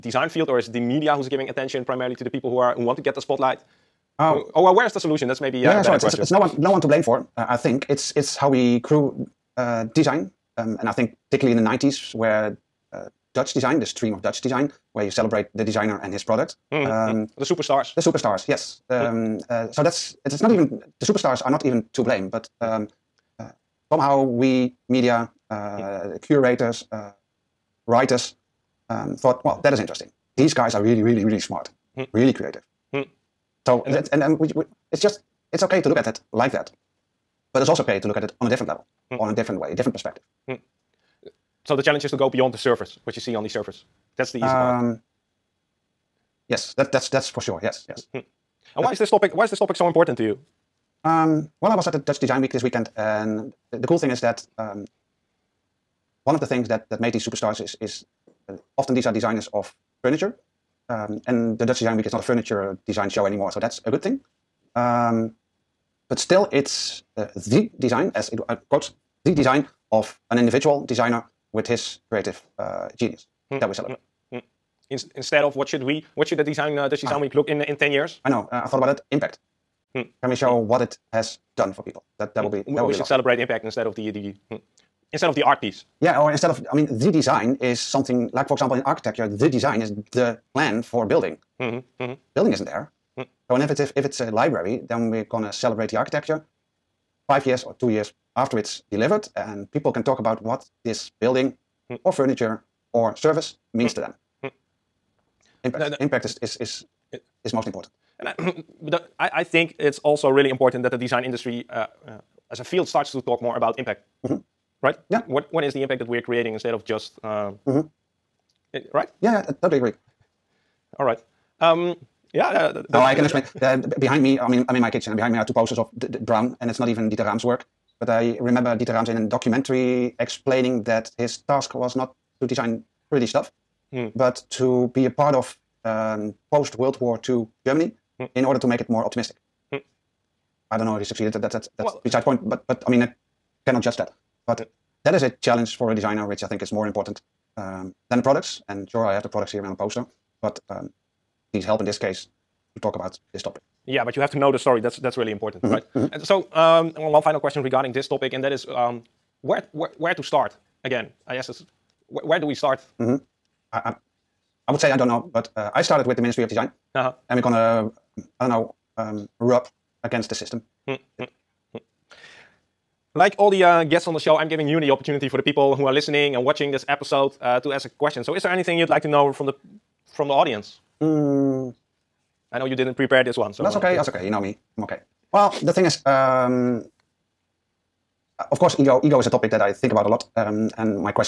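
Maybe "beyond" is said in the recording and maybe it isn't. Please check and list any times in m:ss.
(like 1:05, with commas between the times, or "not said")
0:42.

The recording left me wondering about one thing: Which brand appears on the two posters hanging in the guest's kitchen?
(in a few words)
Braun.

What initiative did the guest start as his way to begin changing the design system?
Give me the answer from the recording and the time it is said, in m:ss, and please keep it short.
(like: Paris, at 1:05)
the Ministry of Design, at 2:46.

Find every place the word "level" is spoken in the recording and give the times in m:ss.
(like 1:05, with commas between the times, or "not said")
0:38.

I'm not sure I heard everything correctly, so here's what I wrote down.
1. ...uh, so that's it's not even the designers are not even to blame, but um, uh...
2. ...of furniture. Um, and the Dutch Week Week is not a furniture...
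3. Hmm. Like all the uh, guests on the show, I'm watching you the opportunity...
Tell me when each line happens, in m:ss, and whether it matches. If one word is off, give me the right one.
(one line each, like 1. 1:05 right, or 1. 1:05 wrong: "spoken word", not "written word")
1. 0:19 wrong: "superstars", not "designers"
2. 0:59 wrong: "Design", not "Week"
3. 2:50 wrong: "giving", not "watching".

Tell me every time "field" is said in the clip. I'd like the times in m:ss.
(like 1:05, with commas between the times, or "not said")
0:00, 1:52.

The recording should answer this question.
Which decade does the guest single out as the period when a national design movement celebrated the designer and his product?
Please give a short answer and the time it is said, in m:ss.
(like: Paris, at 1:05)
the '90s, at 0:11.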